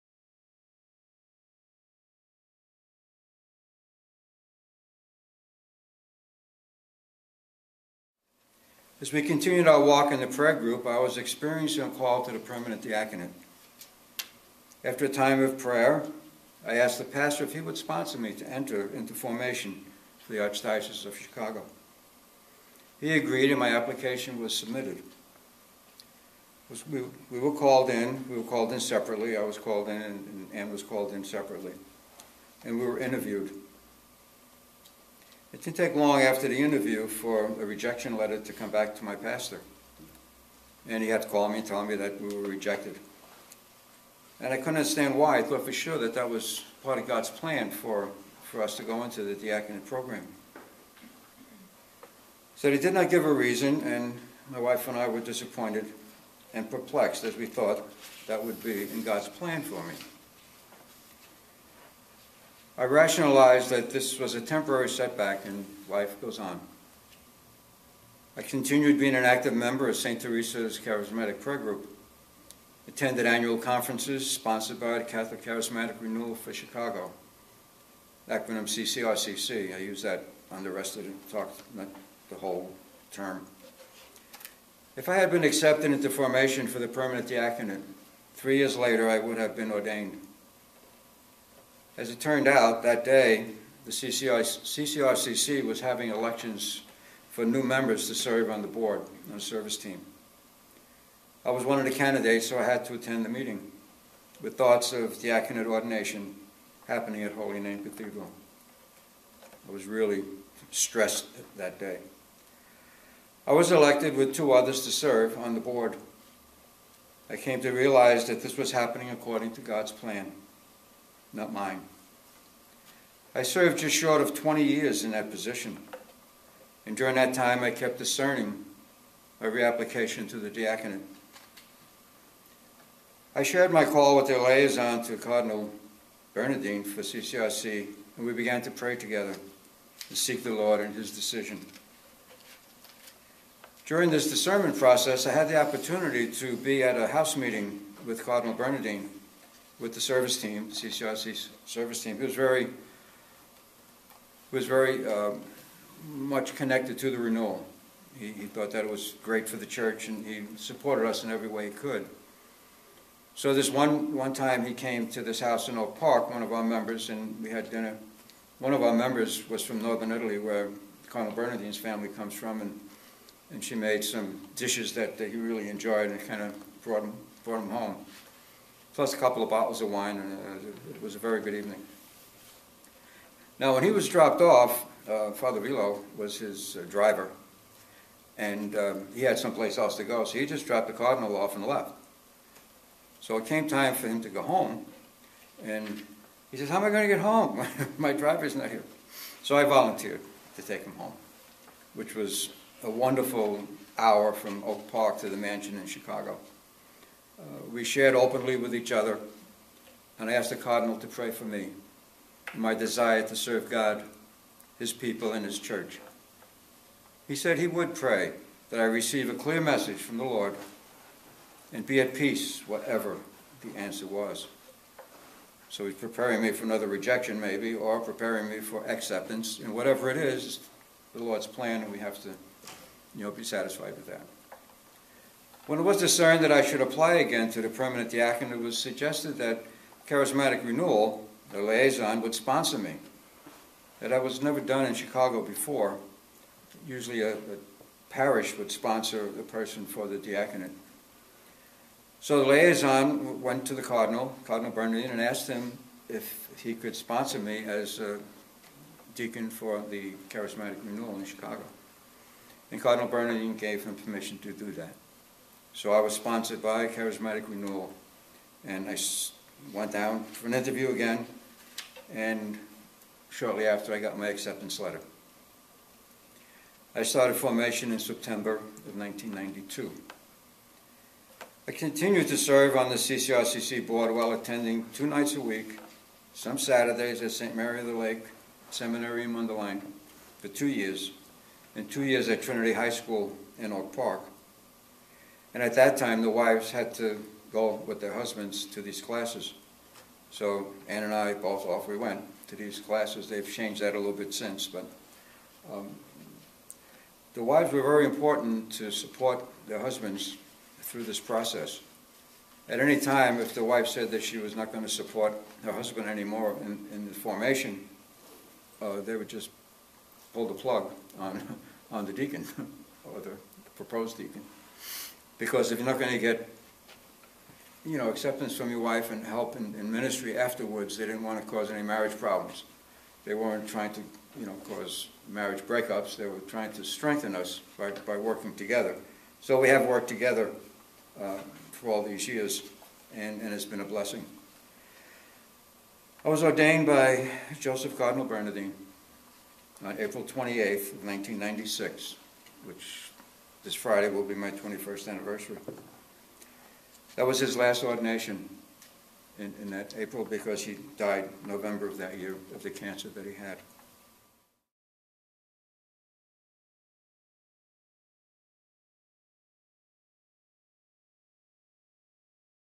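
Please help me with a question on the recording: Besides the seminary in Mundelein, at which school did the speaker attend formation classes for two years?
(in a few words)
Trinity High School.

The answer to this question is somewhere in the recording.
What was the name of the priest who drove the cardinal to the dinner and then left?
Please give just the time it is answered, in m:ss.
3:05.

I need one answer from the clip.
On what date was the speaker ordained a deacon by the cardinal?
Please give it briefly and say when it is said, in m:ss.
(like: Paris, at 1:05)
April 28, 1996, at 5:49.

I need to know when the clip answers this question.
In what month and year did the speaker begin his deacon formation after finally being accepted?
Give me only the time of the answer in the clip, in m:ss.
4:37.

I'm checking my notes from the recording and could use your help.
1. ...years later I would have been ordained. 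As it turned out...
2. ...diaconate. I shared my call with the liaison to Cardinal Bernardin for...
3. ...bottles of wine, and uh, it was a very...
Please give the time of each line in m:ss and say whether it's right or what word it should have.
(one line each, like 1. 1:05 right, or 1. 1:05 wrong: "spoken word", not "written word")
1. 1:28 right
2. 2:10 right
3. 2:59 right.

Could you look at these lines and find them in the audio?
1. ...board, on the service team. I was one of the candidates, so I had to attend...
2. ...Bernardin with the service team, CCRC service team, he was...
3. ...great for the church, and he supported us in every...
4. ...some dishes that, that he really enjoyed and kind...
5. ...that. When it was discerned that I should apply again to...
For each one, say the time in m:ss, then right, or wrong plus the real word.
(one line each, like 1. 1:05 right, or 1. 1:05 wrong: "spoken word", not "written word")
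1. 1:38 right
2. 2:28 right
3. 2:39 right
4. 2:54 right
5. 3:54 right.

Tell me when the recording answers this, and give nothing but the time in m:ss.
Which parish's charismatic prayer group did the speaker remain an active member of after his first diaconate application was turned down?
1:09.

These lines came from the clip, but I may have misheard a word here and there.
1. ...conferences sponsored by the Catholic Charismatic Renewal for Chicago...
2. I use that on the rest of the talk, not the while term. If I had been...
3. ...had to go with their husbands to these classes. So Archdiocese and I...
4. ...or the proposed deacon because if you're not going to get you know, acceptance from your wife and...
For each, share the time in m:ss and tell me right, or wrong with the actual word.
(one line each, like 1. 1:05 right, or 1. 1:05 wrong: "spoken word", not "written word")
1. 1:13 right
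2. 1:19 wrong: "whole", not "while"
3. 4:56 wrong: "Ann", not "Archdiocese"
4. 5:23 right.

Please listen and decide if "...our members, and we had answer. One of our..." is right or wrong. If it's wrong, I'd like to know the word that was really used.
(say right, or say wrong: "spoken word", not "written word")
wrong: "dinner", not "answer".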